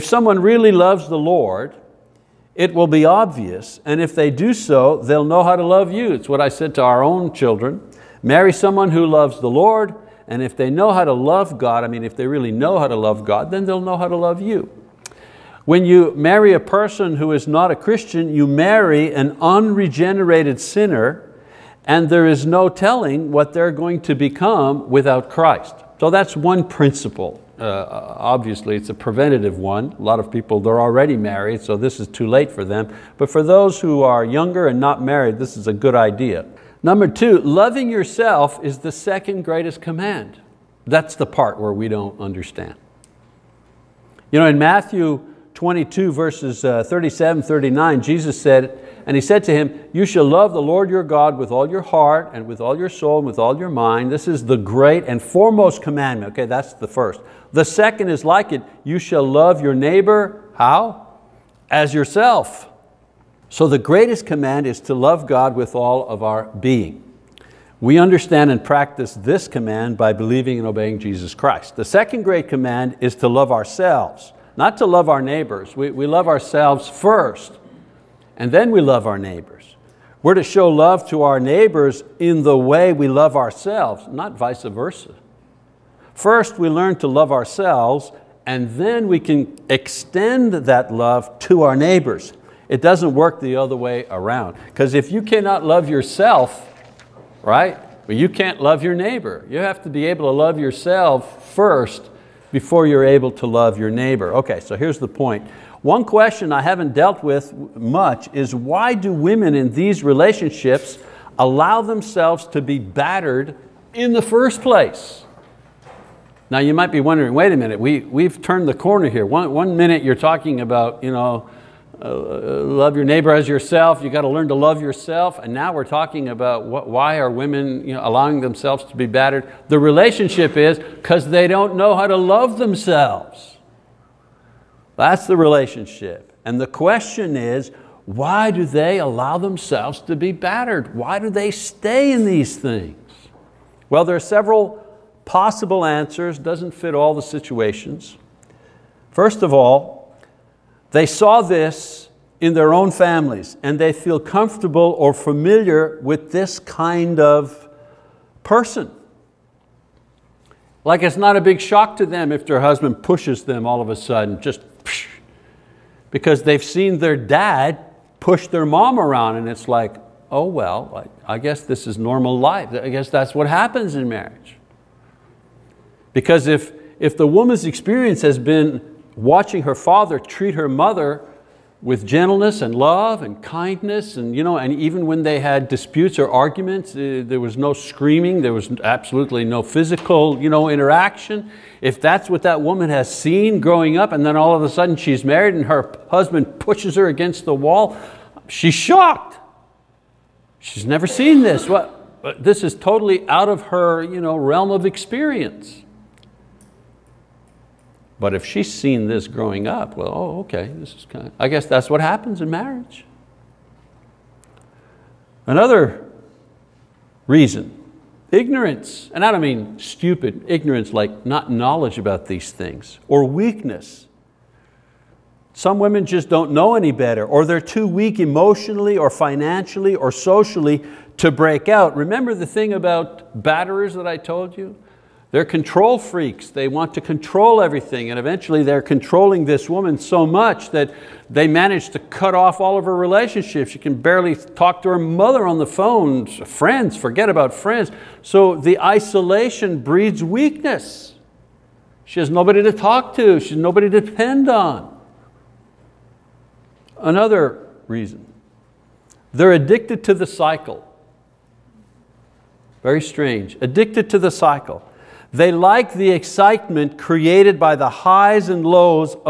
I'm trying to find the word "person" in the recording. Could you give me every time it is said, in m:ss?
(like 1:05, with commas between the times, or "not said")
0:16, 2:38.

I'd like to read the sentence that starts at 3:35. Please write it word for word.
Another reason, ignorance, and I don't mean stupid, ignorance like not knowledge about these things, or weakness.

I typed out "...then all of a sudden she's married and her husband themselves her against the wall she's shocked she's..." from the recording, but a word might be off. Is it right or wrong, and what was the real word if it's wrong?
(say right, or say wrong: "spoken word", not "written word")
wrong: "pushes", not "themselves".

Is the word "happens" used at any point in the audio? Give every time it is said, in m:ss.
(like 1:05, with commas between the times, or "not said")
2:53, 3:31.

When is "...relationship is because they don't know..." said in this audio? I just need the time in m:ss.
2:09.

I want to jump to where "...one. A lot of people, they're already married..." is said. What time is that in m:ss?
0:29.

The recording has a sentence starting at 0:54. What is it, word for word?
This is the great and foremost commandment.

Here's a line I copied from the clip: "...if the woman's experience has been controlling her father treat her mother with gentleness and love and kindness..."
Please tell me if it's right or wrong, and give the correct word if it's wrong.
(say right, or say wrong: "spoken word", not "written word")
wrong: "watching", not "controlling".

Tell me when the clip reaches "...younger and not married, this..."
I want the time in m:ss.
0:34.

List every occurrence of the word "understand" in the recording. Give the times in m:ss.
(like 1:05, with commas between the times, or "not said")
0:42, 1:07.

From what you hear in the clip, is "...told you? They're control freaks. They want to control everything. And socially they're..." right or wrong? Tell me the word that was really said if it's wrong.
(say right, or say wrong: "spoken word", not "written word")
wrong: "eventually", not "socially".